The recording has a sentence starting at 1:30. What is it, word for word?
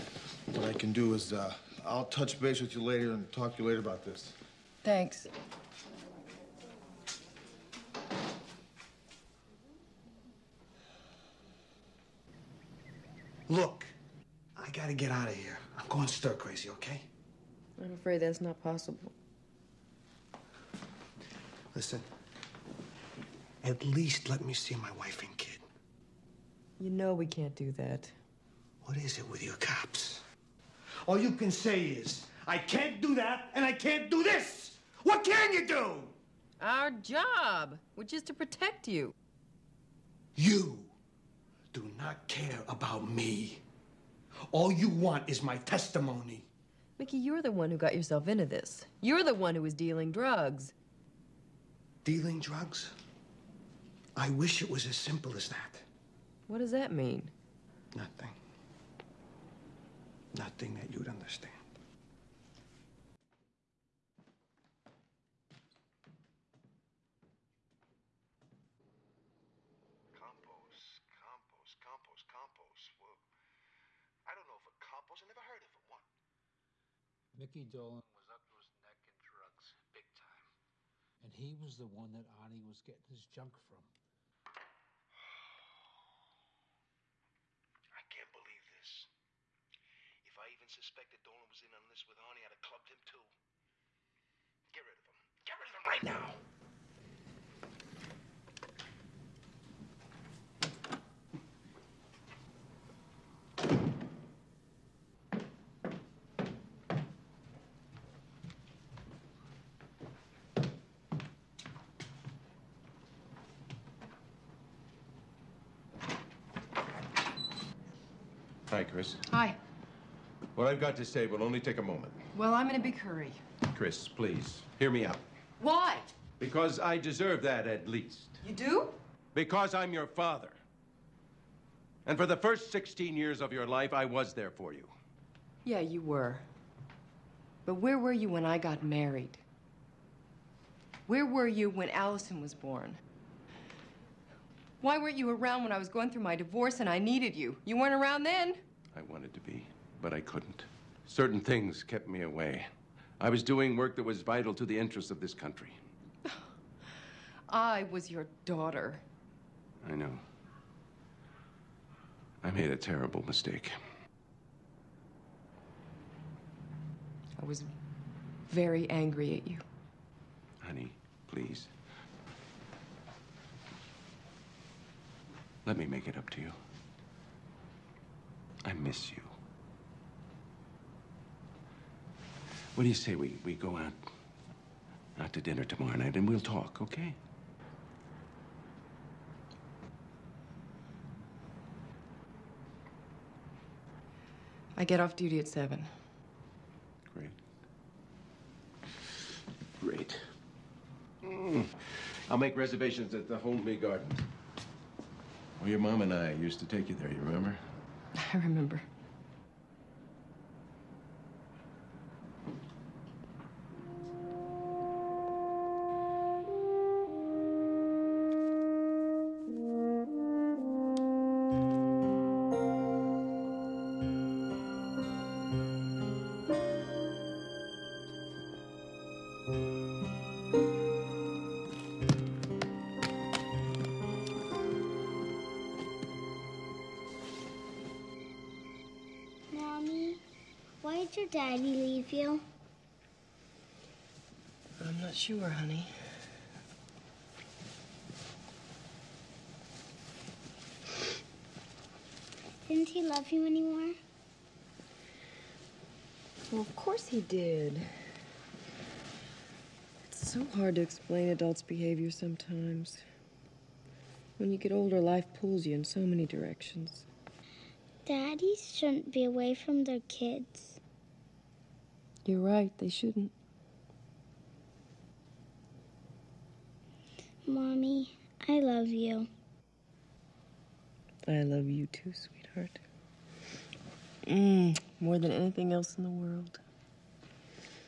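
If I even suspected Dolan was in on this with Arnie, I'd have clubbed him too.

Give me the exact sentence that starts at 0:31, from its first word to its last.
All you can say is, I can't do that and I can't do this.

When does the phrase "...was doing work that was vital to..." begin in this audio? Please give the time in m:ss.
2:33.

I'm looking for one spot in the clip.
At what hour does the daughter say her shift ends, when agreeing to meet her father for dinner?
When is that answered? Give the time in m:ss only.
3:15.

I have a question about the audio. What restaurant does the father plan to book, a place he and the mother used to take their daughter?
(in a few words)
Holmby Gardens.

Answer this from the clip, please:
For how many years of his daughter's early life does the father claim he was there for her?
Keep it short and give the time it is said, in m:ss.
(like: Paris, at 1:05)
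16, at 2:12.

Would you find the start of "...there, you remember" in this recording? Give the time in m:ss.
3:26.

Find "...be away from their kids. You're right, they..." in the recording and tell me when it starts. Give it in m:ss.
4:29.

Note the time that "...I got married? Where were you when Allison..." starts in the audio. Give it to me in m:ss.
2:18.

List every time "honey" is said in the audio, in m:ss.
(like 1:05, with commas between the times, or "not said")
2:50, 4:05.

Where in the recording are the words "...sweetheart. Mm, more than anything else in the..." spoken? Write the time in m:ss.
4:42.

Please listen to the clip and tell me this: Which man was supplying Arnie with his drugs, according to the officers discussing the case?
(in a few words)
Mickey Dolan.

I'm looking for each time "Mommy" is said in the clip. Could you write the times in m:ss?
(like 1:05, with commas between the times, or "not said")
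4:37.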